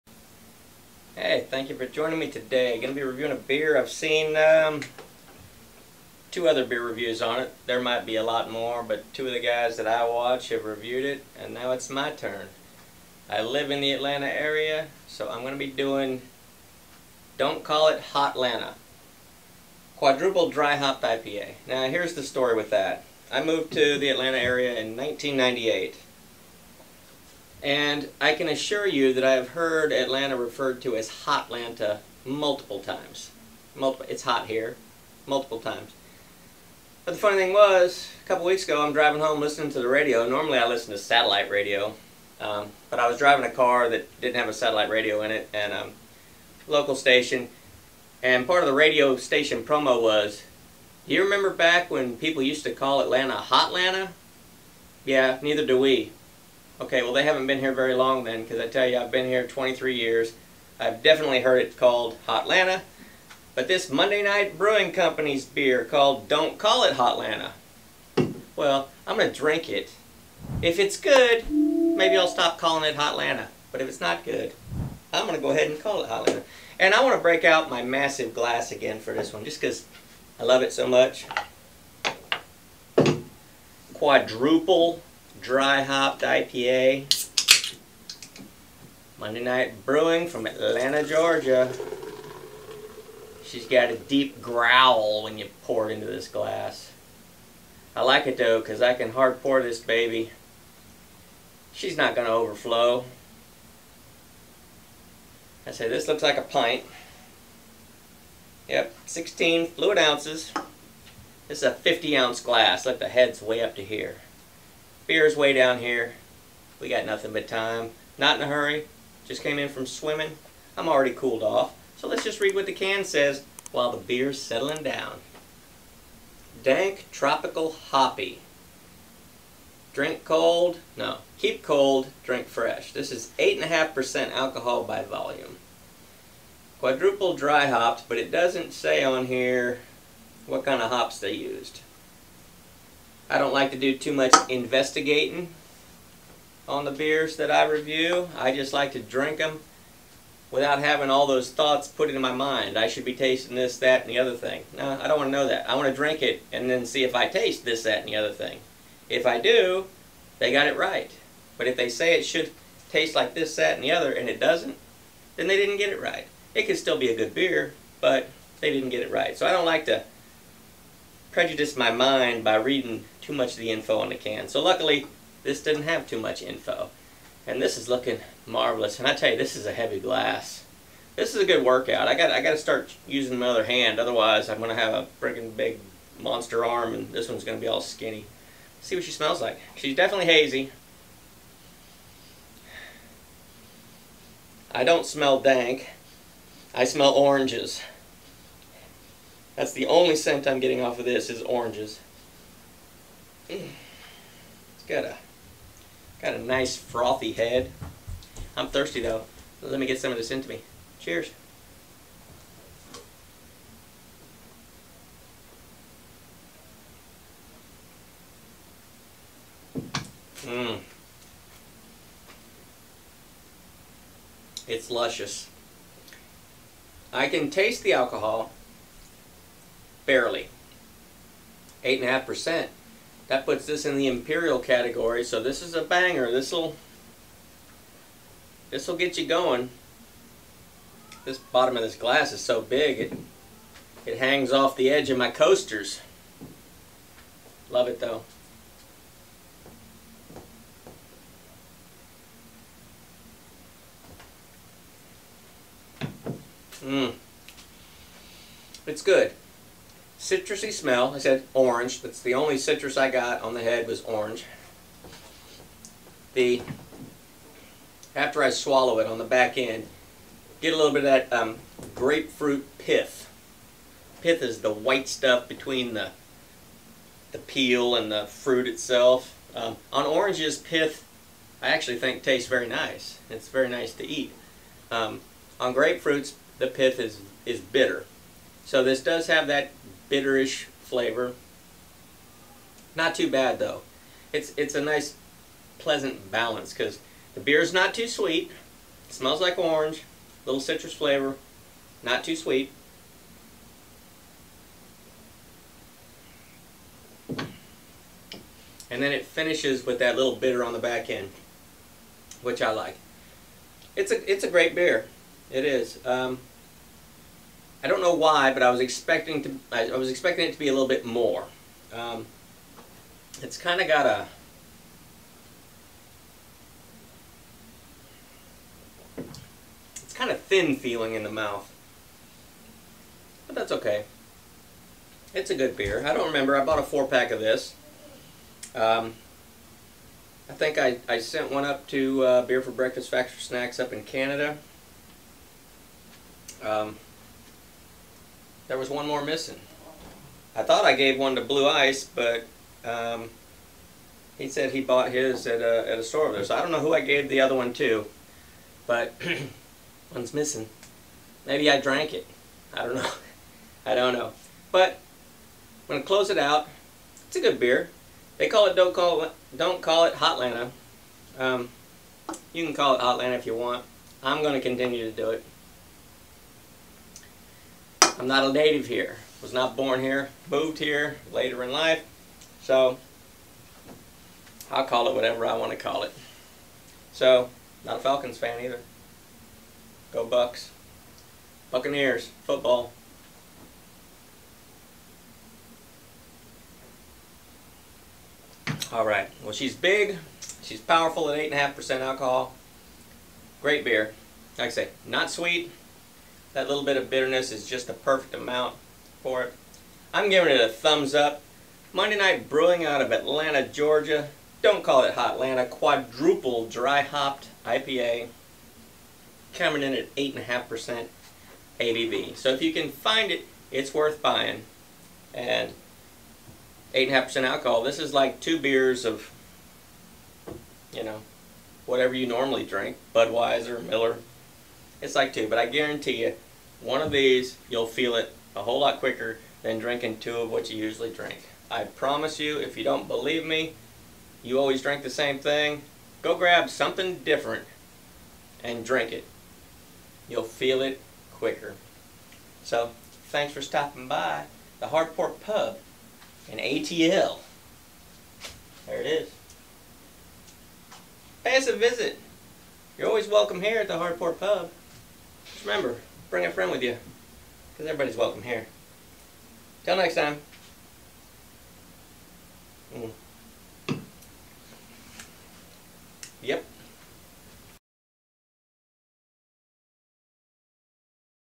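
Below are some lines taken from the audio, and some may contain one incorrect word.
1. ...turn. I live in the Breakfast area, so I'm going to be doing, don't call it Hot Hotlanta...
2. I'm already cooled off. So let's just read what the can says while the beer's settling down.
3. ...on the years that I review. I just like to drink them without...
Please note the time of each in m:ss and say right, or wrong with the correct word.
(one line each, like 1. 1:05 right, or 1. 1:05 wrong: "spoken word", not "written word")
1. 0:12 wrong: "Atlanta", not "Breakfast"
2. 2:00 right
3. 2:26 wrong: "beers", not "years".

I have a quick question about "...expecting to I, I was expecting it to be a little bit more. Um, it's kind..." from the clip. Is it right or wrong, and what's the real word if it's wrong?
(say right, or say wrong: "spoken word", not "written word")
right.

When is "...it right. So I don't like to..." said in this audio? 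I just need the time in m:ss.
2:49.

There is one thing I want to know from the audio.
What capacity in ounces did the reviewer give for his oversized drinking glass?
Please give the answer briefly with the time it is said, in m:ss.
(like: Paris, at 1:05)
50 ounces, at 1:51.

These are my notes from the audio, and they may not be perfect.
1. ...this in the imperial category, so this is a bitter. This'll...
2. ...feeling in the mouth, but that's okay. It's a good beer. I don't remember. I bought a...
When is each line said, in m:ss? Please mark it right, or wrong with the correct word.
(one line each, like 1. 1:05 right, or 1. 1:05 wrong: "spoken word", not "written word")
1. 3:53 wrong: "banger", not "bitter"
2. 5:30 right.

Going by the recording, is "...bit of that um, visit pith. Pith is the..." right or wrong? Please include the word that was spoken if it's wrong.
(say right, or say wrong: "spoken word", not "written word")
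wrong: "grapefruit", not "visit".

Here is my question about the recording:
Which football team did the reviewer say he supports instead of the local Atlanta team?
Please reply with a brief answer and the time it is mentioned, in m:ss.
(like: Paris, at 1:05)
Buccaneers, at 6:31.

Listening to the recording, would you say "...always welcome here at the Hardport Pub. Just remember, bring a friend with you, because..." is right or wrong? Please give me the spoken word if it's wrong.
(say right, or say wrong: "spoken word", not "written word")
right.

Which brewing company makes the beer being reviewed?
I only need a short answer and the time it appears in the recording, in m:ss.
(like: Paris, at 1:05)
Monday Night Brewing Company, at 1:03.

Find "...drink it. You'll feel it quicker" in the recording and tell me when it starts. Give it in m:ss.
7:28.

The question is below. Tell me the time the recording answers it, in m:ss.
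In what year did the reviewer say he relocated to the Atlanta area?
0:24.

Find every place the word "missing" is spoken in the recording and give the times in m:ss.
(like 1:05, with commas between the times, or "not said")
5:49, 6:00.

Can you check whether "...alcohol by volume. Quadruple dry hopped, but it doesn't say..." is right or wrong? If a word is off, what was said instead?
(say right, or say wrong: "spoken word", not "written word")
right.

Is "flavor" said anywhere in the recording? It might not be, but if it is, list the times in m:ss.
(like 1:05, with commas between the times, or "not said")
4:50, 5:00.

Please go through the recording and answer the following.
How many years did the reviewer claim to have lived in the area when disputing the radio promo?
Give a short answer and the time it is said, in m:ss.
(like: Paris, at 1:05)
23, at 0:59.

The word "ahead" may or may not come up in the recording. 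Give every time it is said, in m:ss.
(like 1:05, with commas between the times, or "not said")
1:15.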